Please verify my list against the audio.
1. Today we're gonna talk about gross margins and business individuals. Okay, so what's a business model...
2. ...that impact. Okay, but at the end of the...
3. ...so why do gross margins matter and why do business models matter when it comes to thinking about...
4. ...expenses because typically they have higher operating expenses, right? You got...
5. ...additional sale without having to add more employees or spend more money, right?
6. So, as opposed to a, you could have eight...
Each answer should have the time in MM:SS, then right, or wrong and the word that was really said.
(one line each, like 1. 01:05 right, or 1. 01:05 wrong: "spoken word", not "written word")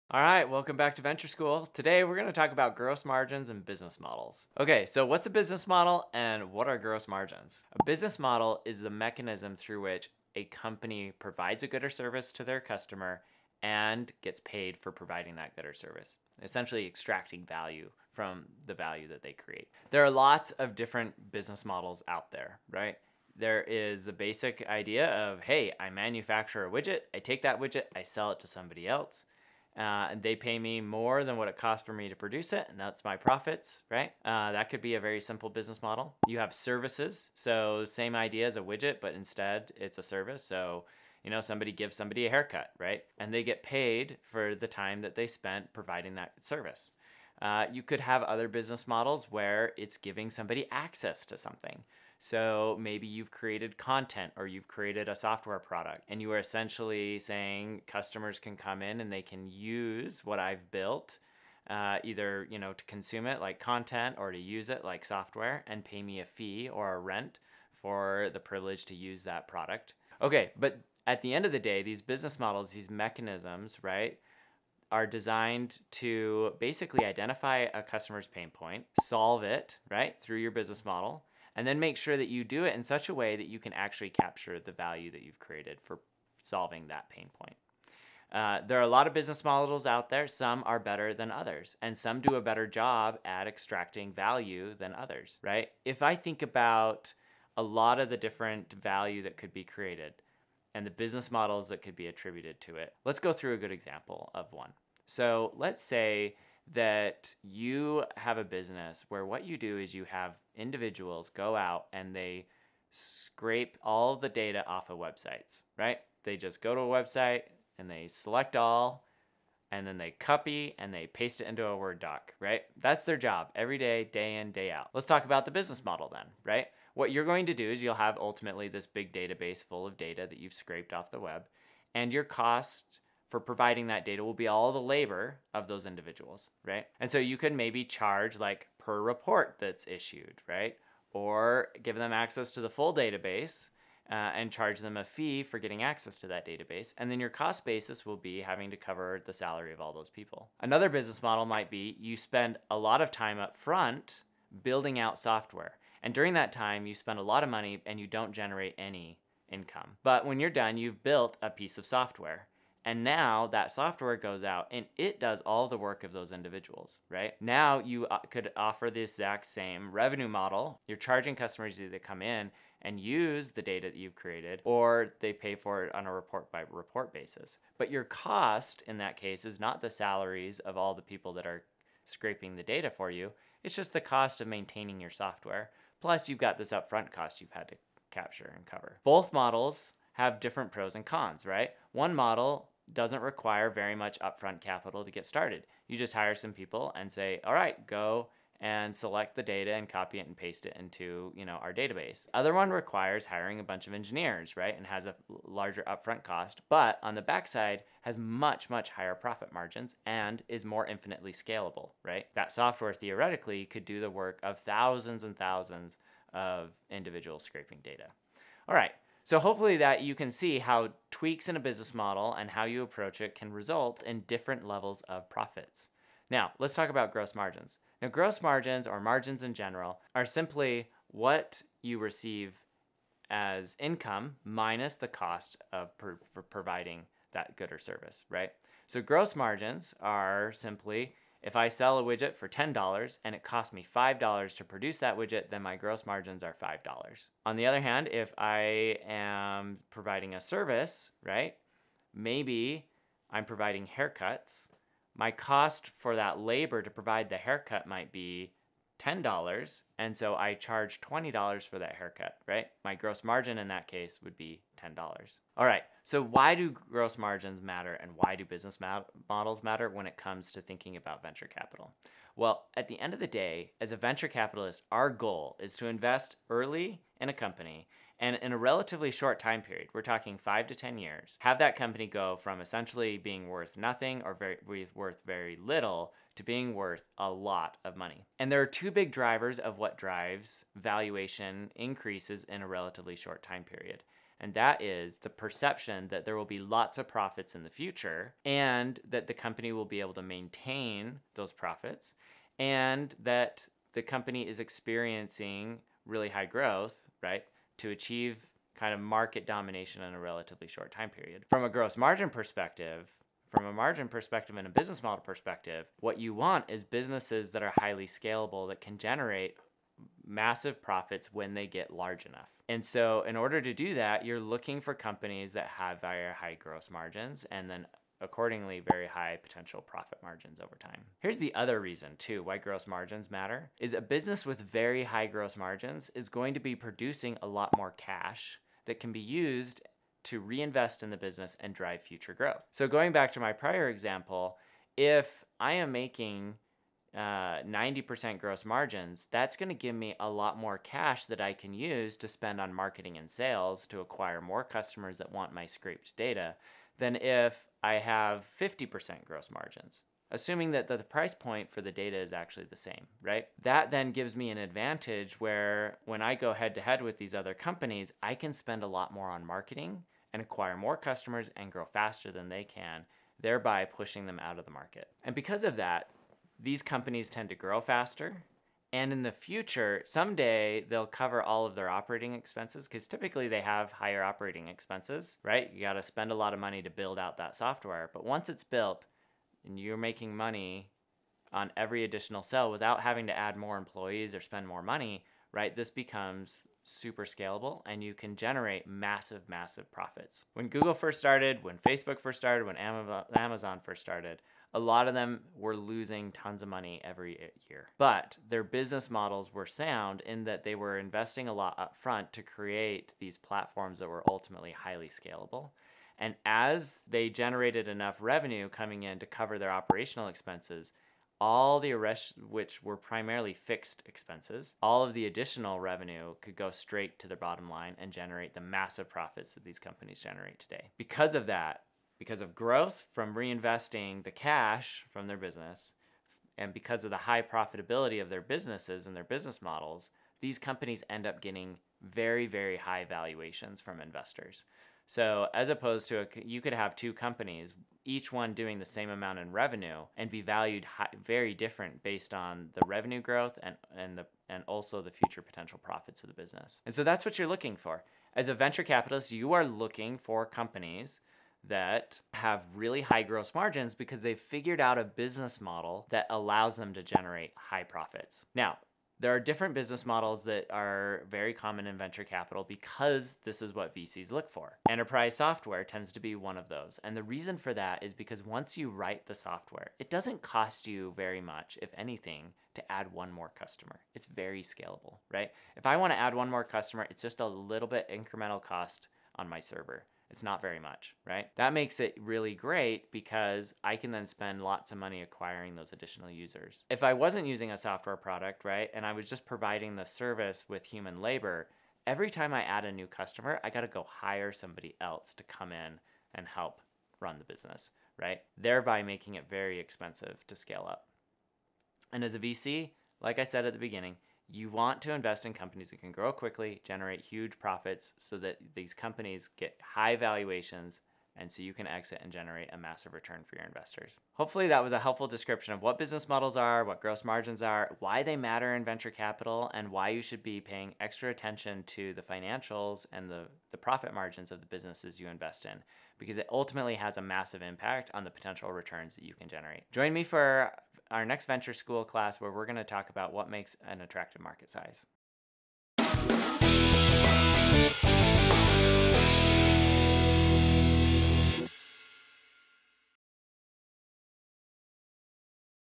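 1. 00:01 wrong: "models", not "individuals"
2. 01:09 wrong: "product", not "impact"
3. 04:26 right
4. 06:22 right
5. 06:32 right
6. 07:25 wrong: "two", not "eight".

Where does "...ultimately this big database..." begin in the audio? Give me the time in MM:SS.
02:08.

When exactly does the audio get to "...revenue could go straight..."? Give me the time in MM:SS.
07:05.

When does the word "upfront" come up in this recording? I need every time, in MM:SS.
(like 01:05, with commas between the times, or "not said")
03:06, 03:14, 03:25.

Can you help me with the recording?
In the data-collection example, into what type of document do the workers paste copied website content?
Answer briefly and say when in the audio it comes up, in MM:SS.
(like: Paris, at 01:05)
Word doc, at 02:01.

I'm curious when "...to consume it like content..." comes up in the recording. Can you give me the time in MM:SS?
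01:02.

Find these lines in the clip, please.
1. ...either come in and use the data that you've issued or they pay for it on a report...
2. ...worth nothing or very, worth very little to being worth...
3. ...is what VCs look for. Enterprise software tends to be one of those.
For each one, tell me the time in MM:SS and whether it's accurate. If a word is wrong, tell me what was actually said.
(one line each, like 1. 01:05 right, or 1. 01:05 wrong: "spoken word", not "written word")
1. 02:51 wrong: "created", not "issued"
2. 04:43 right
3. 07:53 right.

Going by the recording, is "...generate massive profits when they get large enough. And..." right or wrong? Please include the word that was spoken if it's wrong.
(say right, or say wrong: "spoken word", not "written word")
right.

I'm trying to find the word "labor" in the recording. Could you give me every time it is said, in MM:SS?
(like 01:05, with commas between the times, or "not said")
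02:14, 04:16, 08:21.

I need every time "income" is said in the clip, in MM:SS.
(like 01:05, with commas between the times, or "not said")
02:39, 03:53.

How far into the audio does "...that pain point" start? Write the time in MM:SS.
01:26.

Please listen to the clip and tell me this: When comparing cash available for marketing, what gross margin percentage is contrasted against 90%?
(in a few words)
50%.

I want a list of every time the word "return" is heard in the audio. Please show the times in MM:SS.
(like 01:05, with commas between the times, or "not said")
08:43, 08:58.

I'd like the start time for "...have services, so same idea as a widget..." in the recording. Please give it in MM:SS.
00:36.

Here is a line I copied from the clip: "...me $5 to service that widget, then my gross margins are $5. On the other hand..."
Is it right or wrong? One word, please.
wrong.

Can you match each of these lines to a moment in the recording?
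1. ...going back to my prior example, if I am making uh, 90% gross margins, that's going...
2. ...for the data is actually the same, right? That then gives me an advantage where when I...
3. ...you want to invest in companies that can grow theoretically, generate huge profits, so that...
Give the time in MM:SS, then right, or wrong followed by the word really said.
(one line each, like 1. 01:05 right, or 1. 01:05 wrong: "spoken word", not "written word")
1. 05:42 right
2. 06:01 right
3. 08:34 wrong: "quickly", not "theoretically".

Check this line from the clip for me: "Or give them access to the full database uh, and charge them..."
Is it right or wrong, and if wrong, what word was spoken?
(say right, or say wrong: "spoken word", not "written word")
right.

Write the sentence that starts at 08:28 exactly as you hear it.
Thereby making it very expensive to scale up.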